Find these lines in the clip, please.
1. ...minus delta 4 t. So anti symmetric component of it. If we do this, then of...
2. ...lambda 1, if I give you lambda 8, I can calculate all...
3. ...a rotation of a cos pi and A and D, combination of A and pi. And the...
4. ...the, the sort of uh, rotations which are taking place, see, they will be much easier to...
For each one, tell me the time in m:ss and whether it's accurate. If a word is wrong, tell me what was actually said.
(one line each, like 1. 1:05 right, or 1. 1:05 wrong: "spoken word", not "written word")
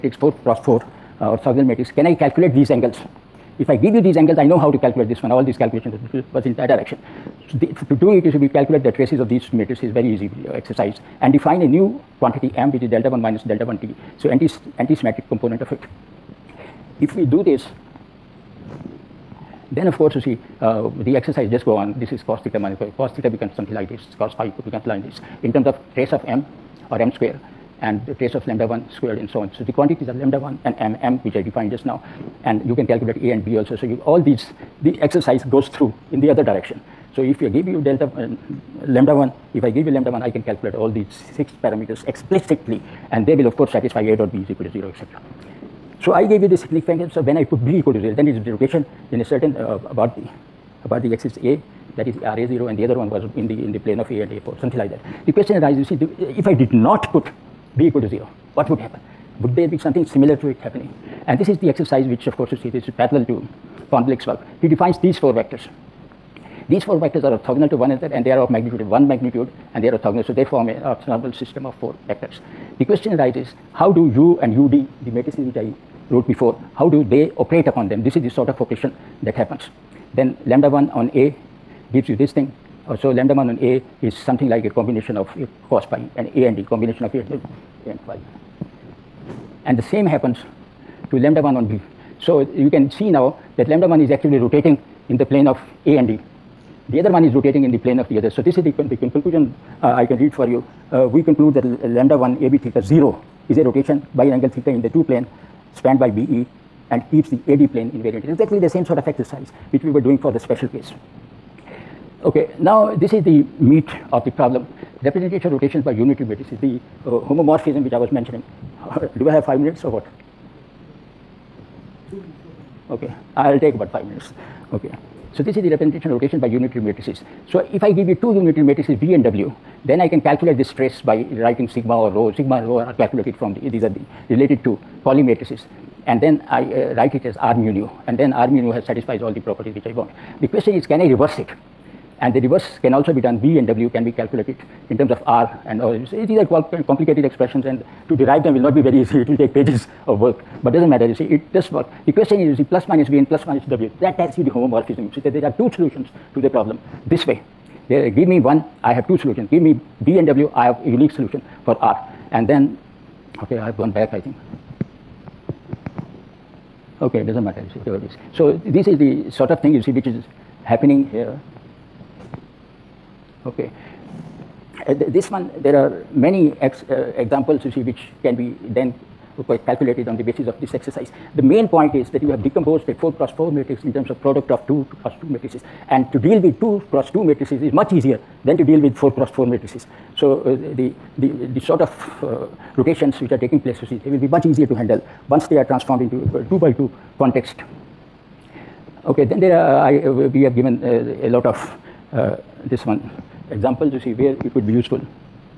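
1. 0:13 wrong: "1", not "4"
2. 0:38 wrong: "1", not "8"
3. 1:24 wrong: "combination", not "rotation"
4. 3:11 right.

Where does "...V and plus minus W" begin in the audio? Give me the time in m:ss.
2:33.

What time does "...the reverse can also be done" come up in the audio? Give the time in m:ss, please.
2:22.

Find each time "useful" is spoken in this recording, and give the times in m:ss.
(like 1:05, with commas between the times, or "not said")
3:24.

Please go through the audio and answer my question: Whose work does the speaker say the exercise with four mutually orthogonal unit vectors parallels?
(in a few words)
von Blake.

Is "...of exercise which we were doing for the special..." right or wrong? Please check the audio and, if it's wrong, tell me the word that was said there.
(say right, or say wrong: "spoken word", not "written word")
right.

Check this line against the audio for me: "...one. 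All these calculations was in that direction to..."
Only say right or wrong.
right.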